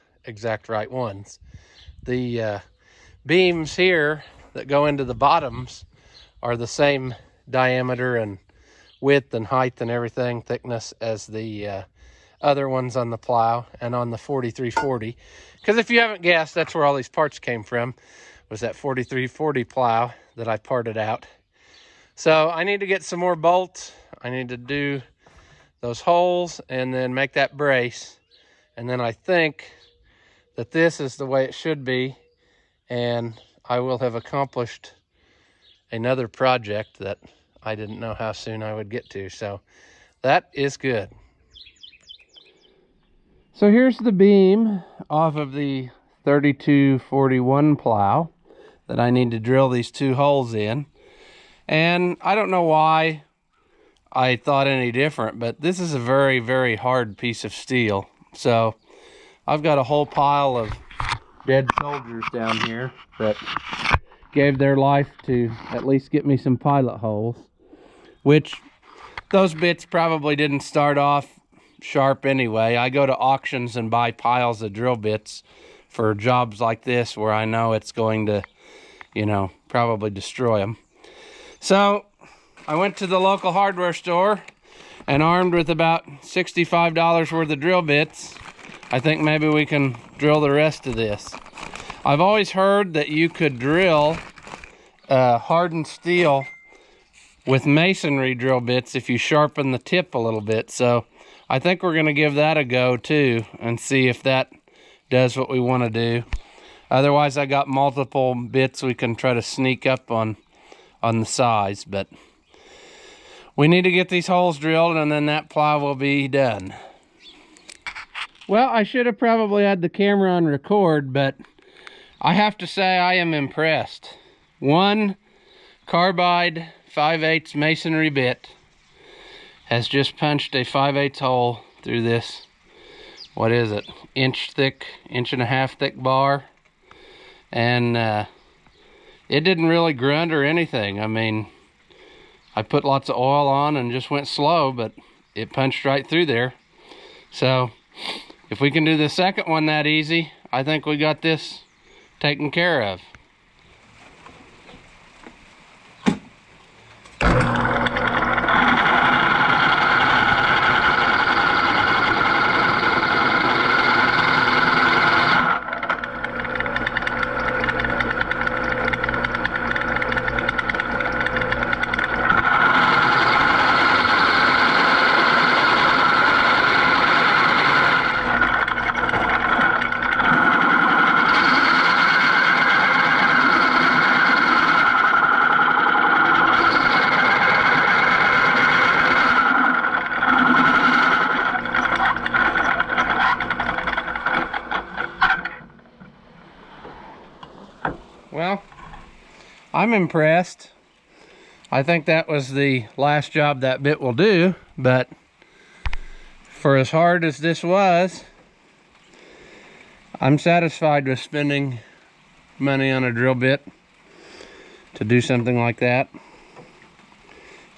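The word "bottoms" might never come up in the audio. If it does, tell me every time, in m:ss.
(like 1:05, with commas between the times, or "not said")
0:05.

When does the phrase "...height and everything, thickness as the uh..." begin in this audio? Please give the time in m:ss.
0:09.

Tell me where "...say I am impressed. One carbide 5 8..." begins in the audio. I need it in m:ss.
2:02.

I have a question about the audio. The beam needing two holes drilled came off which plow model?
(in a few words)
3241.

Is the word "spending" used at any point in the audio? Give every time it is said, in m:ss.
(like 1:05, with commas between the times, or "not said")
3:31.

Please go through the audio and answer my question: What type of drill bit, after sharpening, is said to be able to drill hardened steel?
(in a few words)
masonry drill bits.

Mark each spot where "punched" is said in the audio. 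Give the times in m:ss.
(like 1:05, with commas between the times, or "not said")
2:10, 2:25.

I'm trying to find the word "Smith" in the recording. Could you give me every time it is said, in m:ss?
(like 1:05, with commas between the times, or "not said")
not said.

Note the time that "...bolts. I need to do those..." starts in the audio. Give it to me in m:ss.
0:23.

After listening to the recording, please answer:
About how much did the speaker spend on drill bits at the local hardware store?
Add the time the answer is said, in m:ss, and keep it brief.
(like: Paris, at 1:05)
$65, at 1:26.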